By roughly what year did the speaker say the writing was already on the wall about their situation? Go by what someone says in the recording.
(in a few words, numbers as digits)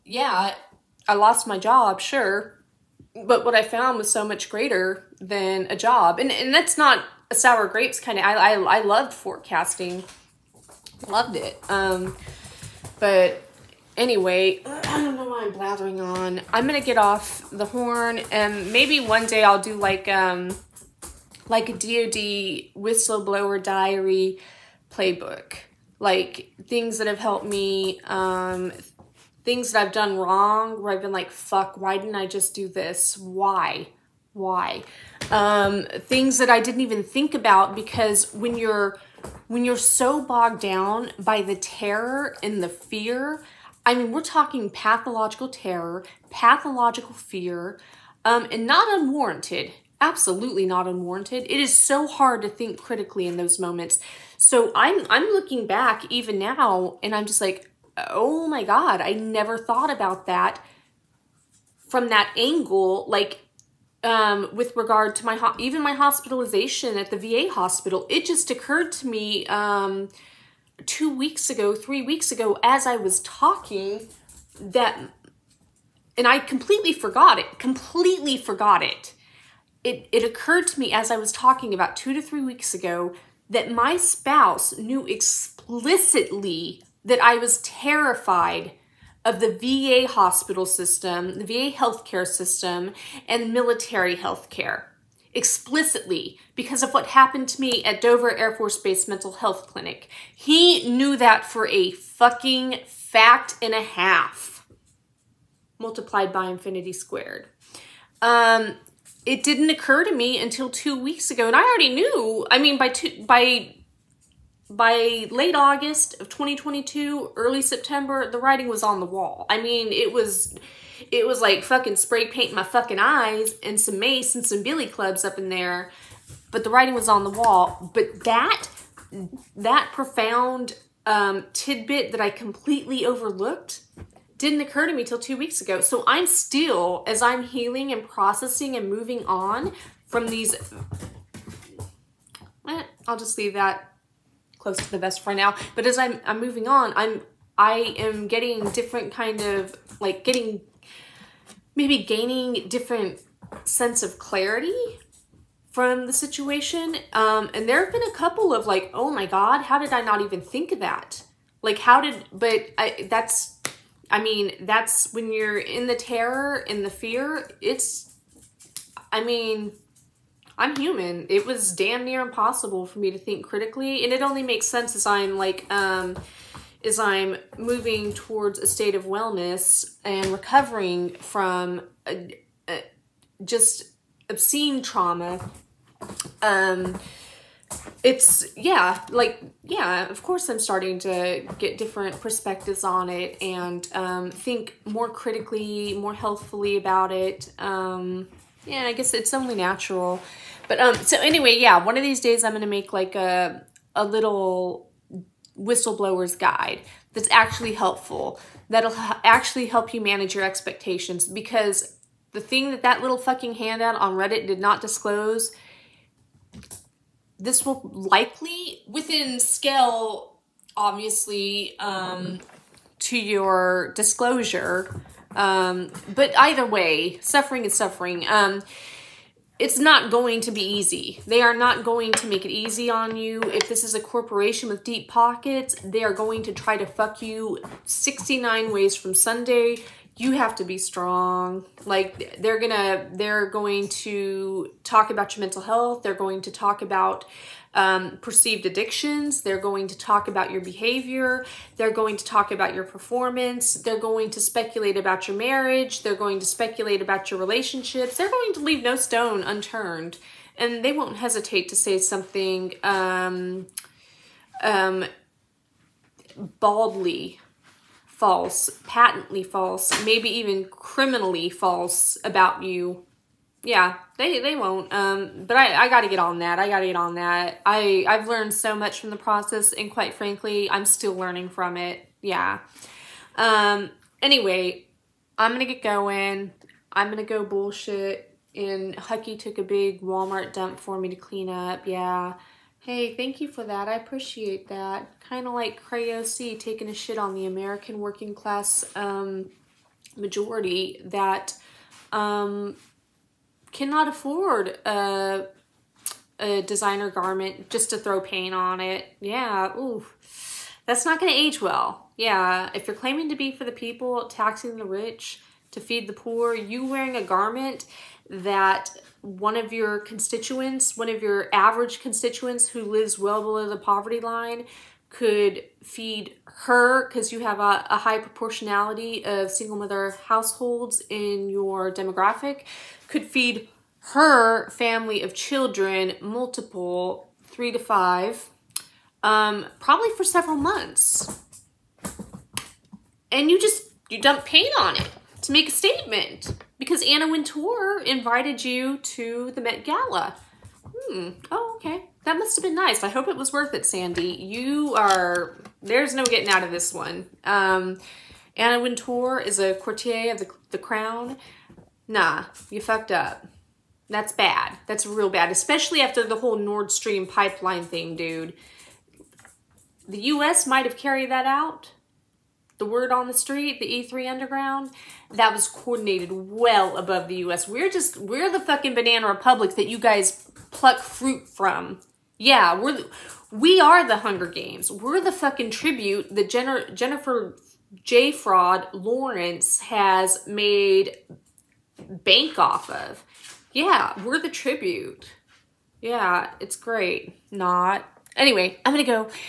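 2022.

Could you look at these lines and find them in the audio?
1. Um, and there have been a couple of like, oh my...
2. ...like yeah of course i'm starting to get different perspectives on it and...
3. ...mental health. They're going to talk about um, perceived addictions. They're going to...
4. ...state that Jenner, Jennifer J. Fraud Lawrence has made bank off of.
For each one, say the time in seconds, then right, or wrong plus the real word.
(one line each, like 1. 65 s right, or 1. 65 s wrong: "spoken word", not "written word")
1. 157 s right
2. 189 s right
3. 245 s right
4. 385 s wrong: "tribute", not "state".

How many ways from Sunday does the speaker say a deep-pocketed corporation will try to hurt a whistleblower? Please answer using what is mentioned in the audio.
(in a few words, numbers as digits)
69.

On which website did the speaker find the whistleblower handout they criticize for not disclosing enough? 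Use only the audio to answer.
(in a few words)
Reddit.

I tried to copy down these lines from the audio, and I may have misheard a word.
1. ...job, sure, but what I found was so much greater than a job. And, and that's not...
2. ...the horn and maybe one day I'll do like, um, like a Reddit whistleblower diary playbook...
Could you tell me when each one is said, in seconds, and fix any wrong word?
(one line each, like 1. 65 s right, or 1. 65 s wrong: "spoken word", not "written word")
1. 1 s right
2. 17 s wrong: "DOD", not "Reddit".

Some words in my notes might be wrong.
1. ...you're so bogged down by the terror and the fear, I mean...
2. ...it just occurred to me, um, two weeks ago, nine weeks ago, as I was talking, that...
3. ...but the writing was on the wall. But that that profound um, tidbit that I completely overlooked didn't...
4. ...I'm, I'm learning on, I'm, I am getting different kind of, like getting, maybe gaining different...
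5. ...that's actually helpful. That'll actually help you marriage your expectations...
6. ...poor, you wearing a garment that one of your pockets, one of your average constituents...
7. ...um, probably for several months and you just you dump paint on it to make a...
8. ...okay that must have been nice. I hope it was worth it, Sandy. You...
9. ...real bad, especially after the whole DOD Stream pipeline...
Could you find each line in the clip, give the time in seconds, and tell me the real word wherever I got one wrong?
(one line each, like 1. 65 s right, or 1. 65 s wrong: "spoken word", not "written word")
1. 39 s right
2. 68 s wrong: "three", not "nine"
3. 126 s right
4. 145 s wrong: "moving", not "learning"
5. 207 s wrong: "manage", not "marriage"
6. 316 s wrong: "constituents", not "pockets"
7. 339 s right
8. 351 s right
9. 365 s wrong: "Nord", not "DOD".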